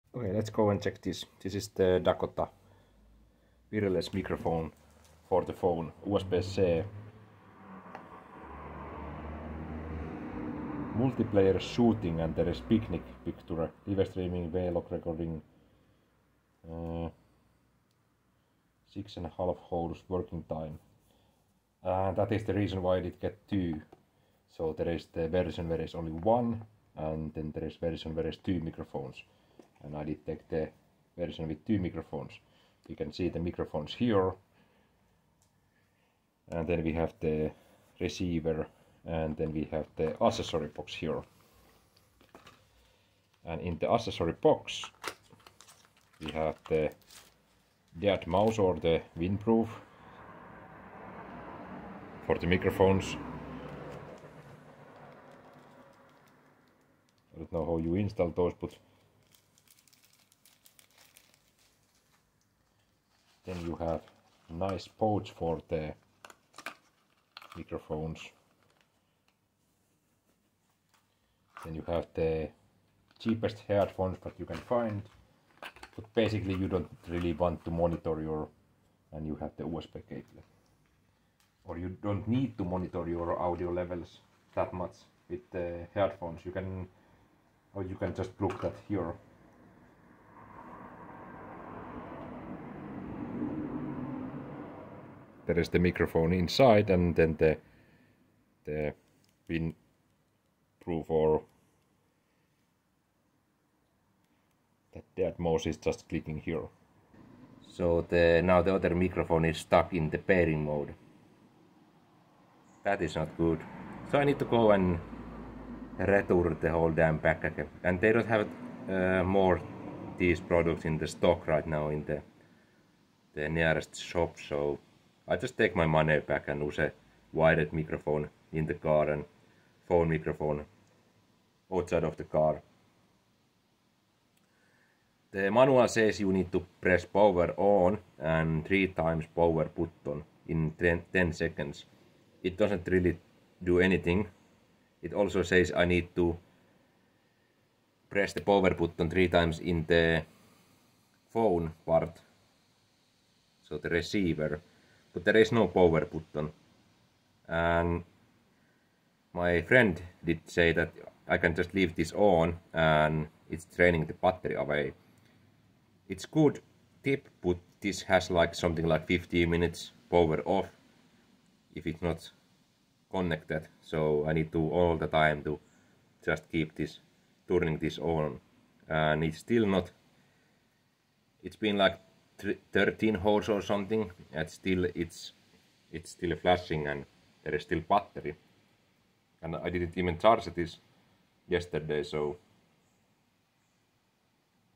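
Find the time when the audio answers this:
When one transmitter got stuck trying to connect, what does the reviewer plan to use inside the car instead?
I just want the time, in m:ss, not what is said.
2:07.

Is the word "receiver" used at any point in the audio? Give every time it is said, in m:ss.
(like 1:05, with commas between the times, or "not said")
0:37, 2:33.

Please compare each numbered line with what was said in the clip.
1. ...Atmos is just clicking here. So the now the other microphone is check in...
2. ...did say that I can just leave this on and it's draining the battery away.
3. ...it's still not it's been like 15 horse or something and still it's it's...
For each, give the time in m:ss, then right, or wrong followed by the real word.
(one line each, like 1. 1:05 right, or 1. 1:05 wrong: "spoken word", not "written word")
1. 1:45 wrong: "stuck", not "check"
2. 2:40 right
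3. 2:59 wrong: "13", not "15".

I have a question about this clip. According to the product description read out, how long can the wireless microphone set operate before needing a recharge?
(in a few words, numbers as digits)
6.5 hours.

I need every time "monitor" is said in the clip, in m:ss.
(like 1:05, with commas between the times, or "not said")
1:17, 1:22.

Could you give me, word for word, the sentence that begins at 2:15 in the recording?
The manual says you need to press power on and three times power button in 10, 10 seconds.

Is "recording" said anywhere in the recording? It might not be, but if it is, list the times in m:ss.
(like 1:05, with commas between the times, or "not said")
0:14.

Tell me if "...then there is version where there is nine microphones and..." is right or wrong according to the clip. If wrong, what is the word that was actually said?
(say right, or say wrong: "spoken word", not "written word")
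wrong: "two", not "nine".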